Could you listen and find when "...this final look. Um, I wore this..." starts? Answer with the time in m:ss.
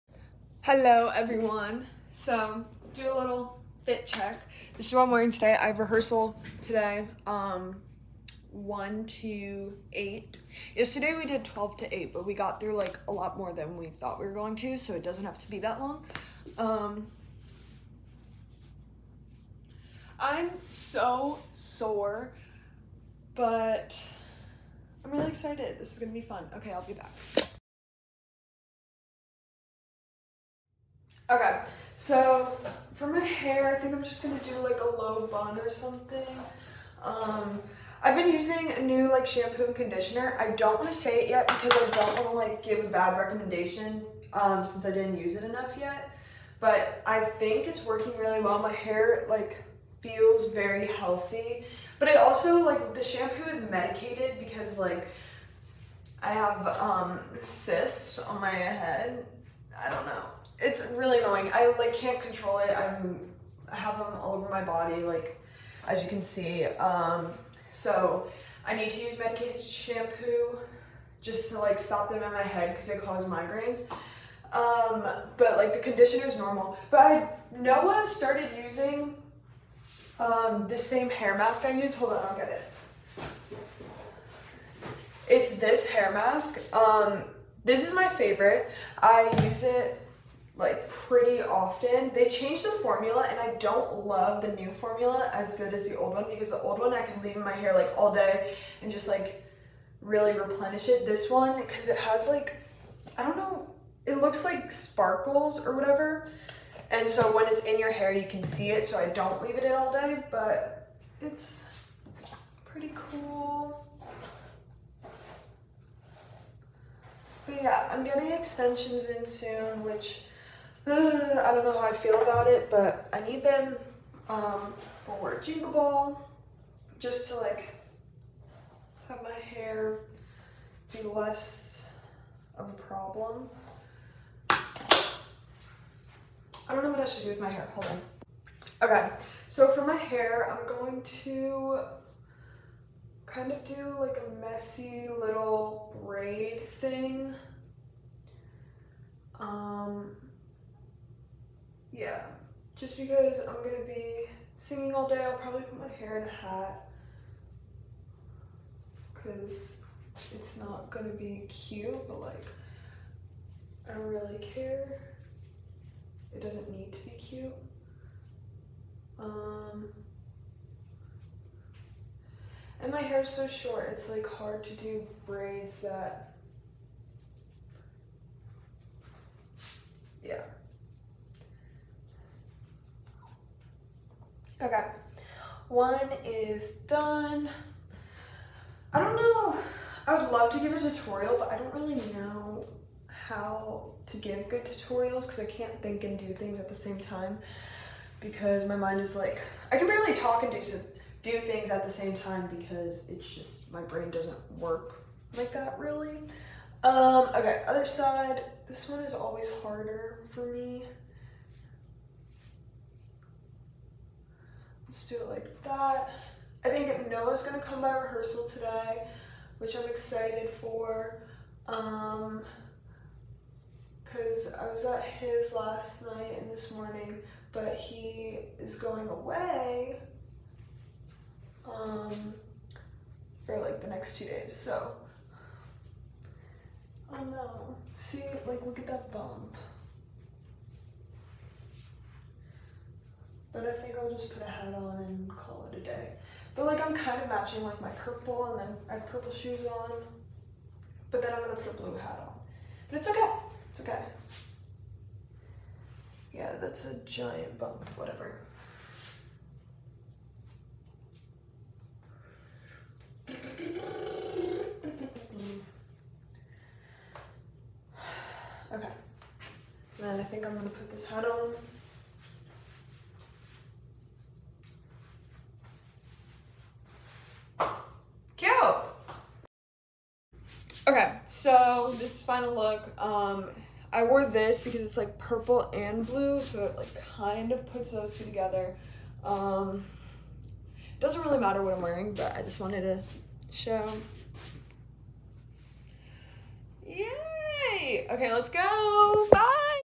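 4:41.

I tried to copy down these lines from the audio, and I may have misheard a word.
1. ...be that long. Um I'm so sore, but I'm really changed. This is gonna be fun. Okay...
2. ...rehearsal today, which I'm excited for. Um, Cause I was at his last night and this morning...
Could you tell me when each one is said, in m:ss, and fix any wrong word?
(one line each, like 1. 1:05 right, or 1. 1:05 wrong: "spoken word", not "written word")
1. 0:15 wrong: "excited", not "changed"
2. 3:37 right.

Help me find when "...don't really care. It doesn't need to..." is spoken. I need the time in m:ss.
2:43.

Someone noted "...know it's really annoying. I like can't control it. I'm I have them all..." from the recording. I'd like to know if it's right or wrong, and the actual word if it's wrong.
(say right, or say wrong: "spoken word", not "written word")
right.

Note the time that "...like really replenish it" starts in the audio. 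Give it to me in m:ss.
1:39.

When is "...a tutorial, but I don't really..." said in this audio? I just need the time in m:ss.
3:10.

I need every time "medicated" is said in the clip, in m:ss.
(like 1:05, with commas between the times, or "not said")
0:53, 1:09.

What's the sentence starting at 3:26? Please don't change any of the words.
Um, okay, other side, this one is always harder for me.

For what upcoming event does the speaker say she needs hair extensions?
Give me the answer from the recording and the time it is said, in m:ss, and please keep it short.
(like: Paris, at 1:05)
Jingle Ball, at 2:05.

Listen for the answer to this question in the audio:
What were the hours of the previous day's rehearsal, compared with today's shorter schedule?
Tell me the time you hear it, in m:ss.
0:11.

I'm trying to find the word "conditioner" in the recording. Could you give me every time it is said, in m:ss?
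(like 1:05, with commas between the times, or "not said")
0:39, 1:15.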